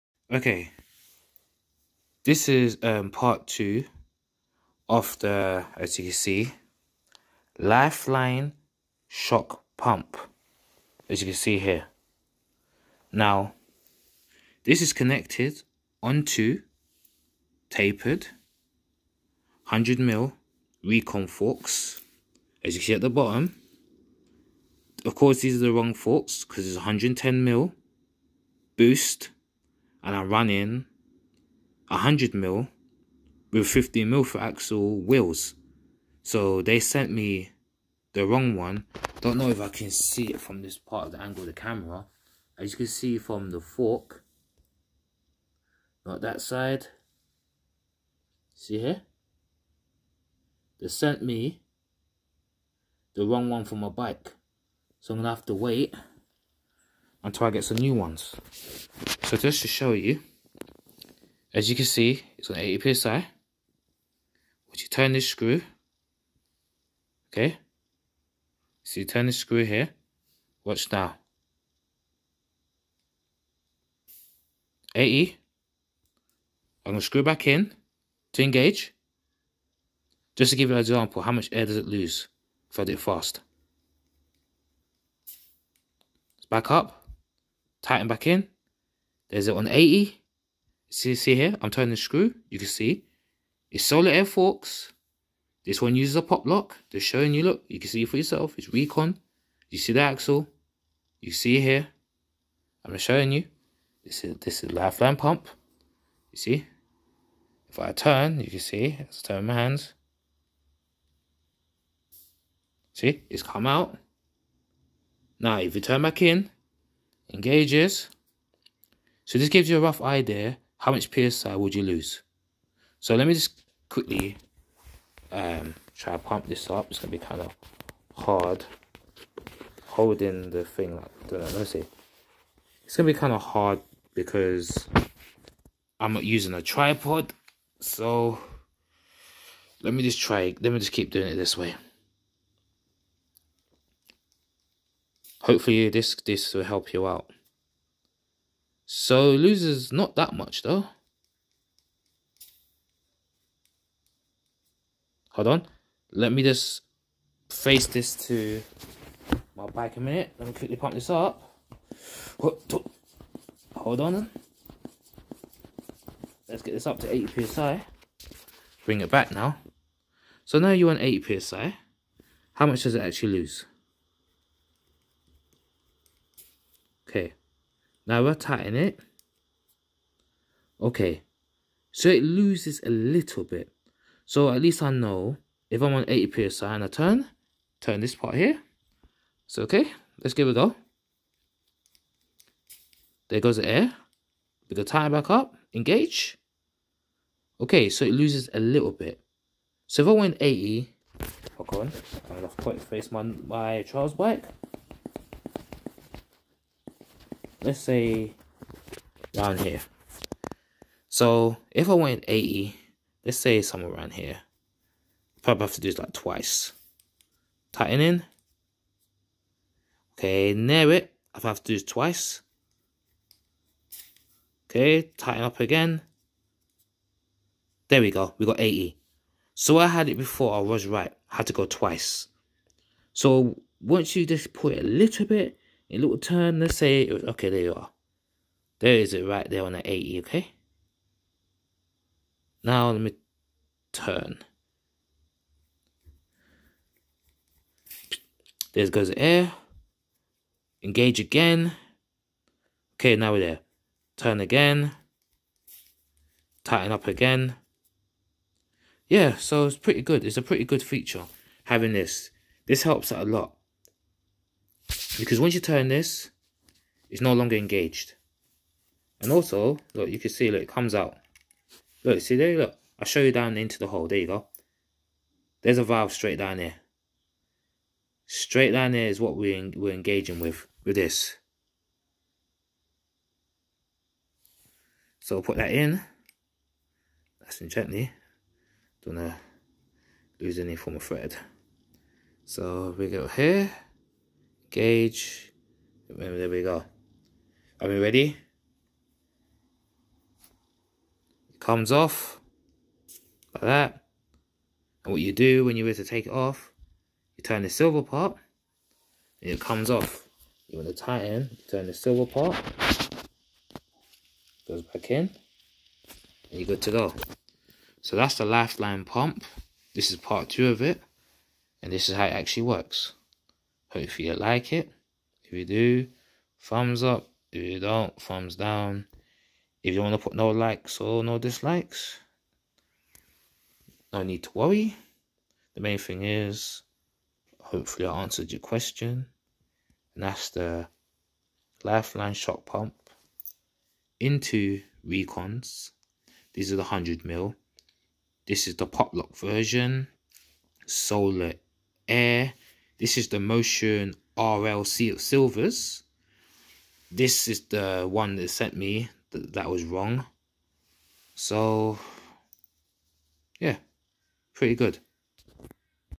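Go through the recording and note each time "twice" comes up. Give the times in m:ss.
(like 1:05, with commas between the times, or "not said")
3:36, 3:41, 3:51.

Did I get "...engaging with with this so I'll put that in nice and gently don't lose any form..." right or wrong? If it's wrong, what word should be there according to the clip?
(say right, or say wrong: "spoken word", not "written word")
right.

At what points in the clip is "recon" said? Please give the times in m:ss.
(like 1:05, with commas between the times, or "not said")
0:20, 1:38, 5:45.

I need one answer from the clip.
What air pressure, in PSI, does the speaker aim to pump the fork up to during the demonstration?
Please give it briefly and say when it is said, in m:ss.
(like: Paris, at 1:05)
80, at 2:46.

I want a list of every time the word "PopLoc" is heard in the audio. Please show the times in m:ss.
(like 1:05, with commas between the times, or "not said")
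1:36, 5:48.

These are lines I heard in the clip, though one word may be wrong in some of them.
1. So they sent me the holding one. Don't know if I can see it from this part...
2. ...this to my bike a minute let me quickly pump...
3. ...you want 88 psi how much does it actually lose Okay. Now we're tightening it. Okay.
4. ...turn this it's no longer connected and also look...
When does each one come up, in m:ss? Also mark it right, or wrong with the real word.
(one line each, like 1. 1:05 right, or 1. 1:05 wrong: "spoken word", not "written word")
1. 0:36 wrong: "wrong", not "holding"
2. 2:37 right
3. 2:50 wrong: "80", not "88"
4. 4:25 wrong: "engaged", not "connected".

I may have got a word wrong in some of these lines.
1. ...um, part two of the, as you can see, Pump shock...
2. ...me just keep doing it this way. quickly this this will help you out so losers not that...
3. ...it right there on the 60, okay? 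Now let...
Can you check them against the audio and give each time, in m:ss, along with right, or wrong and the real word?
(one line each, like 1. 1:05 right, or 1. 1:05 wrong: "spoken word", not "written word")
1. 0:02 wrong: "Lifeline", not "Pump"
2. 2:20 wrong: "hopefully", not "quickly"
3. 3:59 wrong: "80", not "60".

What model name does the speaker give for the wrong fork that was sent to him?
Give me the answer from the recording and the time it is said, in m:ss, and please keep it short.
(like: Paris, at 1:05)
Motion RL Silvers, at 5:53.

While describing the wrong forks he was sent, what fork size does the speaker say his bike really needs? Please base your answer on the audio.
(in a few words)
110 mil boost.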